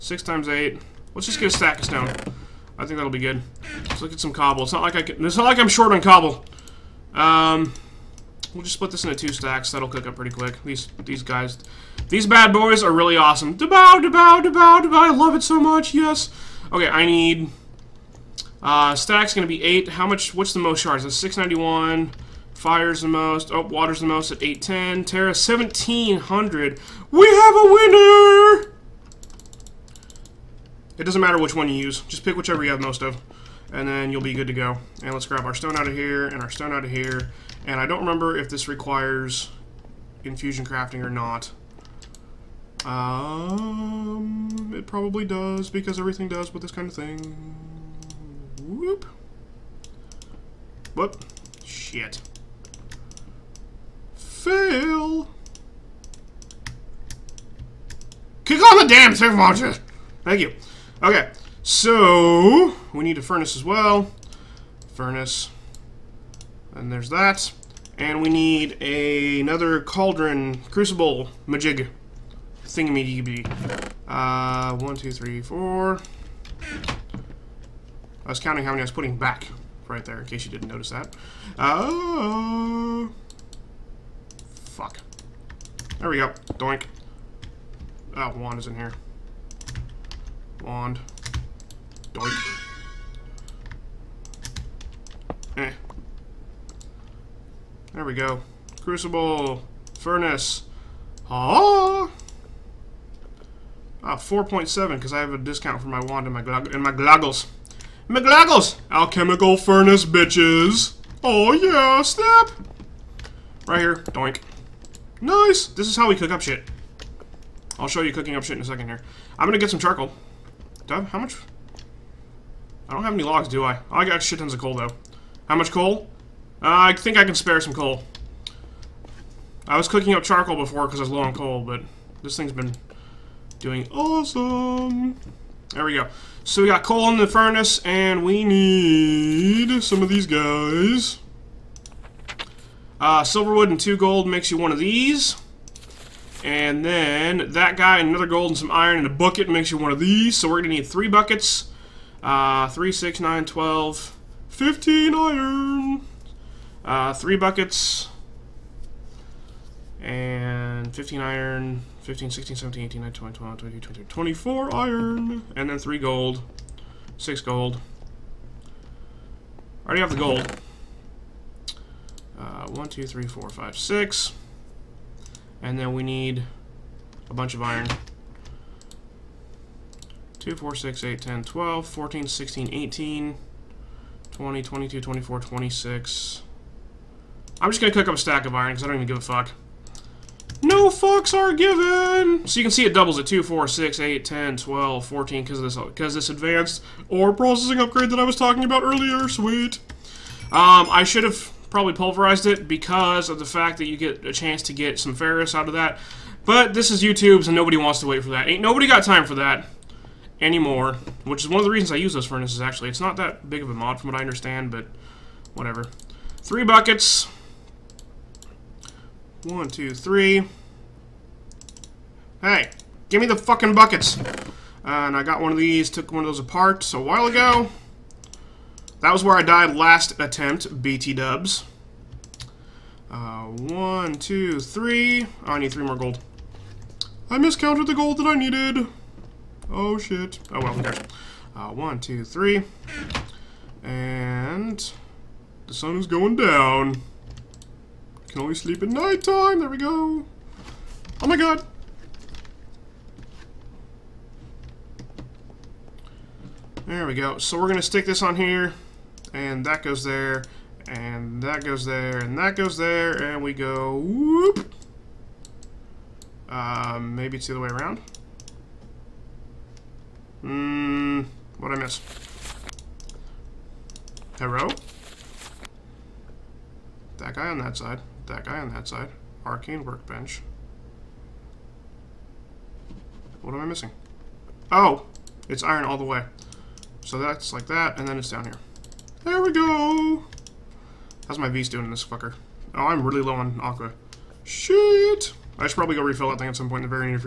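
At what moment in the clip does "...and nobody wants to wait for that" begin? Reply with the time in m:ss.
3:27.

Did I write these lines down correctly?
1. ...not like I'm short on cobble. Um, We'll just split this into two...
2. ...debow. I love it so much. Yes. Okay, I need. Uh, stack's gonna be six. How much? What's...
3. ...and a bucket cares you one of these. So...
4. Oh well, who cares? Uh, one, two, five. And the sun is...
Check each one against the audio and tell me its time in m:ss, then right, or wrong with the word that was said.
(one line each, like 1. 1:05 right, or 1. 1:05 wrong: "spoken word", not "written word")
1. 0:05 right
2. 0:14 wrong: "eight", not "six"
3. 2:28 wrong: "makes", not "cares"
4. 4:00 wrong: "three", not "five".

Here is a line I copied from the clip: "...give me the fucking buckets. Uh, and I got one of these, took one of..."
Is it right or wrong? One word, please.
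right.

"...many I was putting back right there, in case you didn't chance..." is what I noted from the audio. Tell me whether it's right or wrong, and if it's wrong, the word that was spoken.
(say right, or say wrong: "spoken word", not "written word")
wrong: "notice", not "chance".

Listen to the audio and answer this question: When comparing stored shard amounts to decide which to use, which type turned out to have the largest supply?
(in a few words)
Terra.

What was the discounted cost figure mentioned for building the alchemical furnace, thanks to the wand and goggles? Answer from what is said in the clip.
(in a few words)
4.7.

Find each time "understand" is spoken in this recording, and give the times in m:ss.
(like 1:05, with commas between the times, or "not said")
3:34.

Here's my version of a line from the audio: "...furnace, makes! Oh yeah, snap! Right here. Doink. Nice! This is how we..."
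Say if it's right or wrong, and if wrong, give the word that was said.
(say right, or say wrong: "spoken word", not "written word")
wrong: "bitches", not "makes".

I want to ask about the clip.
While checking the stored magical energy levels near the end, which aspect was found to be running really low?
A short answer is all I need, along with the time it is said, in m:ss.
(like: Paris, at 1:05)
aqua, at 4:53.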